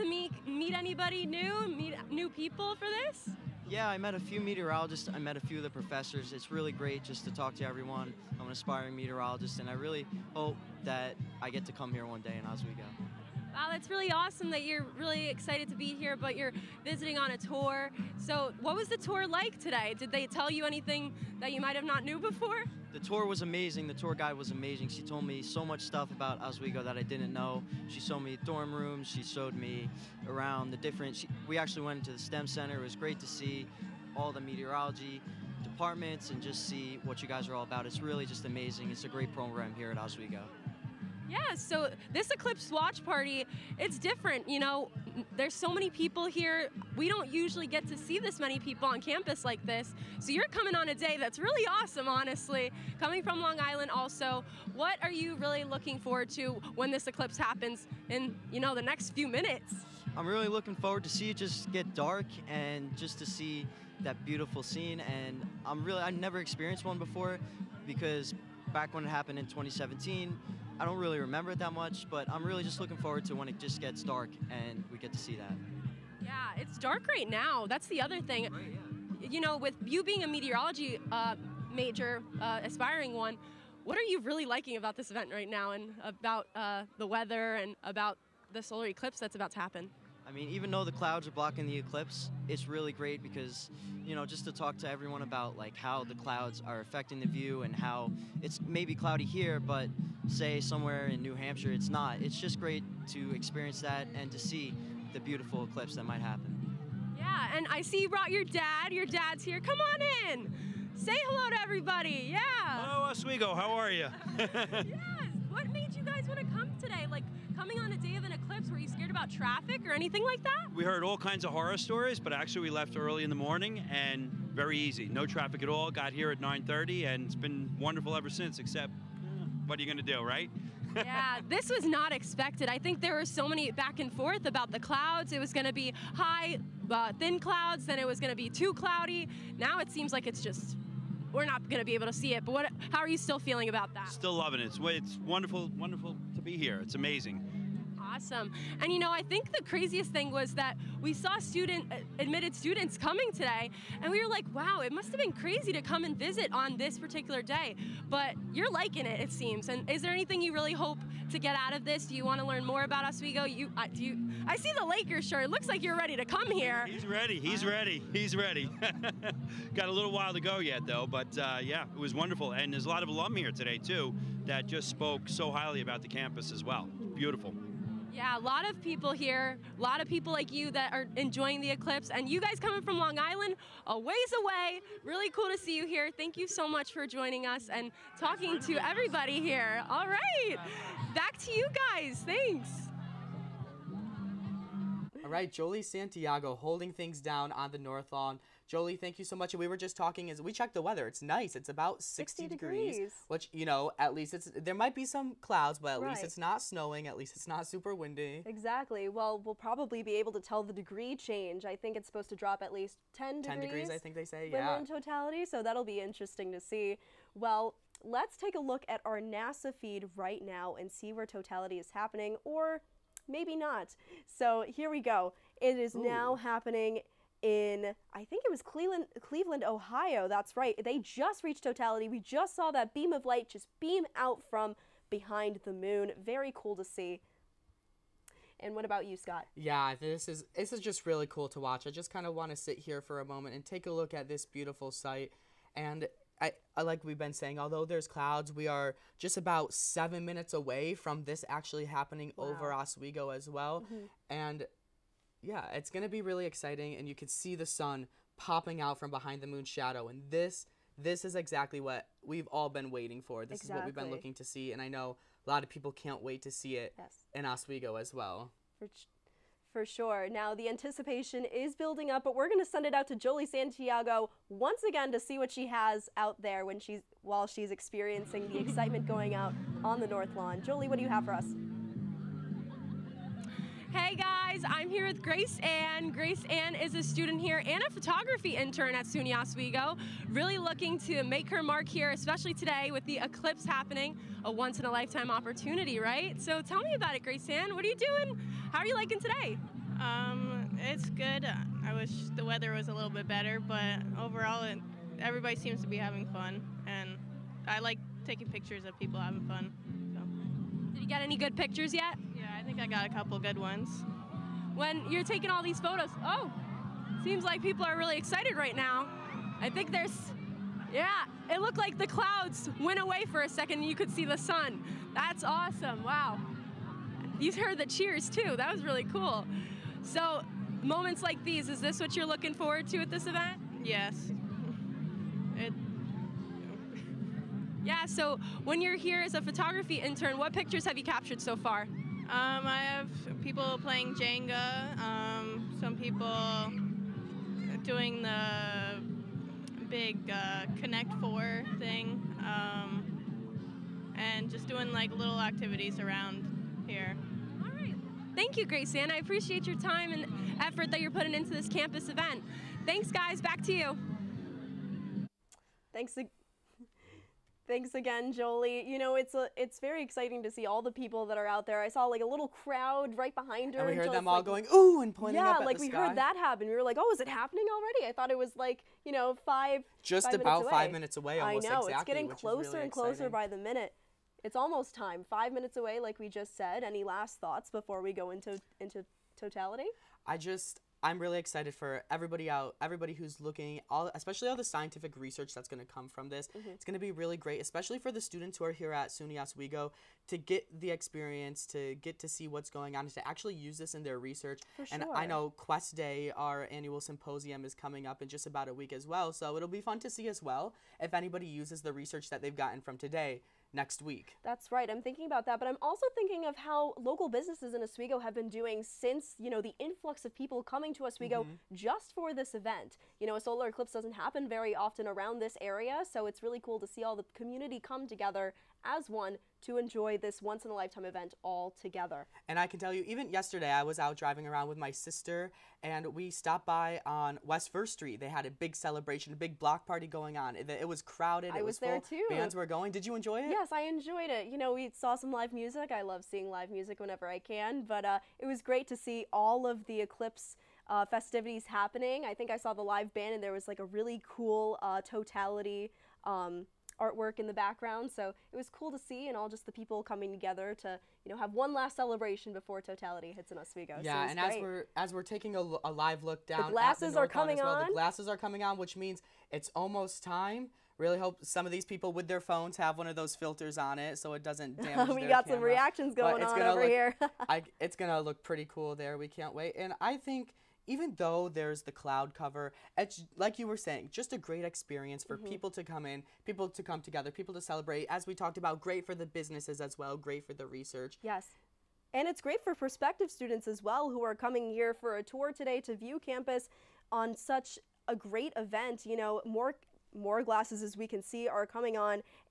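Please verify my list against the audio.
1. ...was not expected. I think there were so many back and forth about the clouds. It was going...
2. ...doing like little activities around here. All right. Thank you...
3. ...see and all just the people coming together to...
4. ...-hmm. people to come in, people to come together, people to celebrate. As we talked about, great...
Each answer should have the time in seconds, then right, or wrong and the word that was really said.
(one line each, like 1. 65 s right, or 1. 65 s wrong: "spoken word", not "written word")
1. 131 s right
2. 354 s right
3. 458 s right
4. 485 s right.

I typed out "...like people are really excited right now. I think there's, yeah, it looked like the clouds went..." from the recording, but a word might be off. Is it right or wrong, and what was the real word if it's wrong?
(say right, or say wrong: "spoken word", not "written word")
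right.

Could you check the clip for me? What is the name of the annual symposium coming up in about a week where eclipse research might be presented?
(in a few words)
Quest Day.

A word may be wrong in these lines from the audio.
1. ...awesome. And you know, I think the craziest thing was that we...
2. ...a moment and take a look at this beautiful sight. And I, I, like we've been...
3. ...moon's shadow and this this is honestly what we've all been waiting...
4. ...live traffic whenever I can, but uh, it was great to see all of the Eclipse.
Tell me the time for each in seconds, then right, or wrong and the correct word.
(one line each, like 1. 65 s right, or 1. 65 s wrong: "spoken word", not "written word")
1. 148 s right
2. 243 s right
3. 259 s wrong: "exactly", not "honestly"
4. 446 s wrong: "music", not "traffic".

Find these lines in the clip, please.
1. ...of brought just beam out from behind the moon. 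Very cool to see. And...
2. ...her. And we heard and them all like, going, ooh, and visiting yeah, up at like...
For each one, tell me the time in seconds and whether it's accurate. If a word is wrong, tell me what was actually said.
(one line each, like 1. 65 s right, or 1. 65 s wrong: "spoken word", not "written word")
1. 233 s wrong: "light", not "brought"
2. 373 s wrong: "pointing", not "visiting".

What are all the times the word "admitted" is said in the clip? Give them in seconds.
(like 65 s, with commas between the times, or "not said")
152 s.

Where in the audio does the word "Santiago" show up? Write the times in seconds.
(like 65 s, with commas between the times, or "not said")
195 s, 273 s.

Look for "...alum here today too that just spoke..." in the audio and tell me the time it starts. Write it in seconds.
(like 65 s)
173 s.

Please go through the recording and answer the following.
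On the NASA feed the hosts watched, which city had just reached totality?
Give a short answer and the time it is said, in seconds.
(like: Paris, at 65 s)
Cleveland, Ohio, at 229 s.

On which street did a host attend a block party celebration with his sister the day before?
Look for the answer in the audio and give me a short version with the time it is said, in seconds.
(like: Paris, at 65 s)
West First Street, at 437 s.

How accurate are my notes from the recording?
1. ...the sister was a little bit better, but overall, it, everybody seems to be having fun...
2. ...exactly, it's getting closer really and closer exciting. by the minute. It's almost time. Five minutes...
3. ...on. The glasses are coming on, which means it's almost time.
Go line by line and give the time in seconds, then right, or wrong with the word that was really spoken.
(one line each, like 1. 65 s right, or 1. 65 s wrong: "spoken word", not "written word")
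1. 302 s wrong: "weather", not "sister"
2. 381 s right
3. 467 s right.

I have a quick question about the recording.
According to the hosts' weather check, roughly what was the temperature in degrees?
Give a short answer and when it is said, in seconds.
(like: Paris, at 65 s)
60, at 202 s.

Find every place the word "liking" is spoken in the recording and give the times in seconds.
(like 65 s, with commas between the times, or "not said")
84 s, 158 s, 298 s.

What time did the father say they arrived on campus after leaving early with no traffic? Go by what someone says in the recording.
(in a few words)
9:30.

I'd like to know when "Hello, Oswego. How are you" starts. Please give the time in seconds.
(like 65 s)
112 s.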